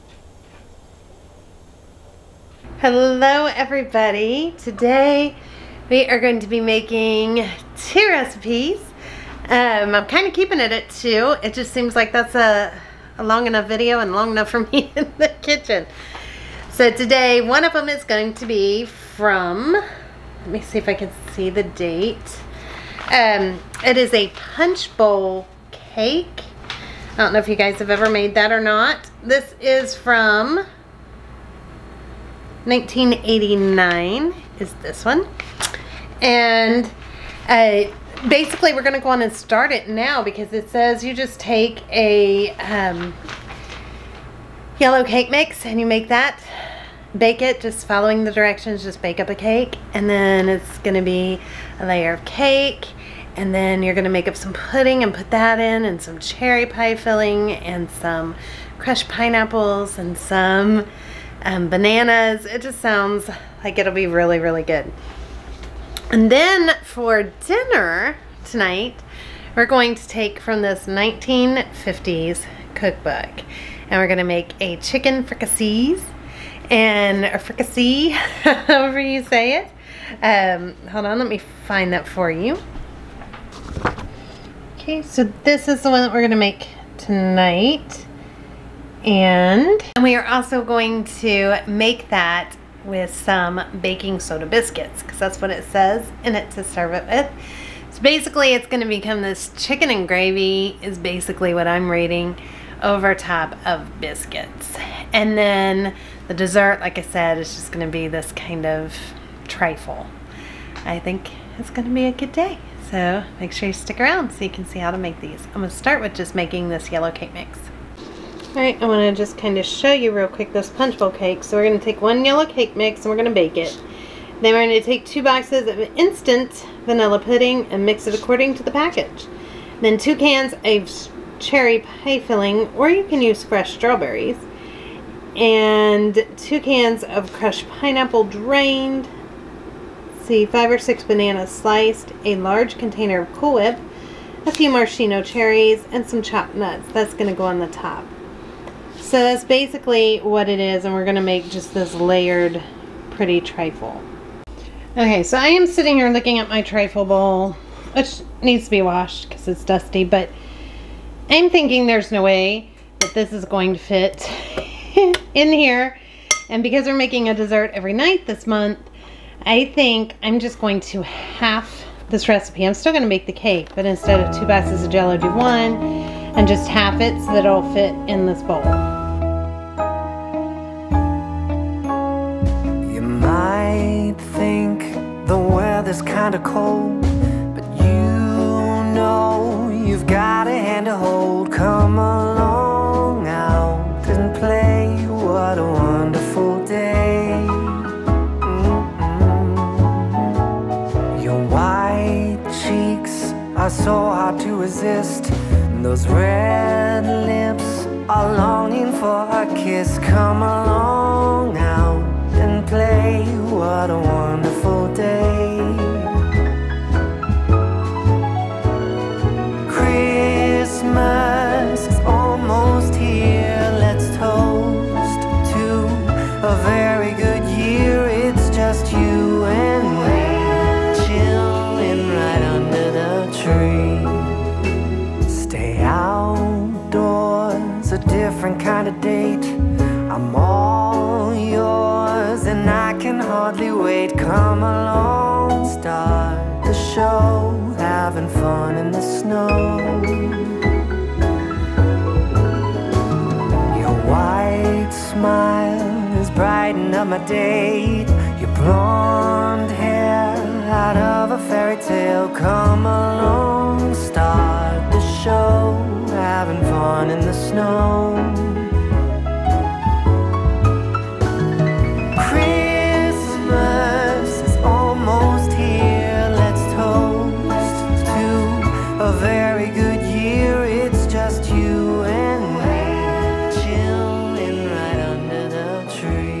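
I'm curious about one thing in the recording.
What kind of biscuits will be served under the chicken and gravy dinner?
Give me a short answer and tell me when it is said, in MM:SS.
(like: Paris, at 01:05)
baking soda biscuits, at 01:33.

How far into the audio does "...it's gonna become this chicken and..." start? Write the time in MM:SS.
01:38.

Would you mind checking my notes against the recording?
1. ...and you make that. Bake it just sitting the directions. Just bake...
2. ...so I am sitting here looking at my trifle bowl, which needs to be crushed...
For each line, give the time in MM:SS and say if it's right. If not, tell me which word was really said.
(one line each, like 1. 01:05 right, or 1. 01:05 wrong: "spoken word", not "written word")
1. 00:45 wrong: "following", not "sitting"
2. 02:35 wrong: "washed", not "crushed".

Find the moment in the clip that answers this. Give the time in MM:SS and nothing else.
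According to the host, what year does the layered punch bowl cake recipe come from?
00:32.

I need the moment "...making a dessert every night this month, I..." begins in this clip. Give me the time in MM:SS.
02:46.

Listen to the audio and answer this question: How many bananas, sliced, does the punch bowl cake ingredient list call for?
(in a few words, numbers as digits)
5 or 6.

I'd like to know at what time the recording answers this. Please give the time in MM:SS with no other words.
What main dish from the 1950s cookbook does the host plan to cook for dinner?
01:14.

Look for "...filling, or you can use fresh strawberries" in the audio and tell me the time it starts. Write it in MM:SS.
02:12.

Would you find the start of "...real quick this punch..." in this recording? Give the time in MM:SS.
02:00.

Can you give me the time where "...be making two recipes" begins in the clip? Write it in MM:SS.
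00:06.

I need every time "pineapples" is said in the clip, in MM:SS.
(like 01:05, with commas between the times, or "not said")
00:59, 02:17.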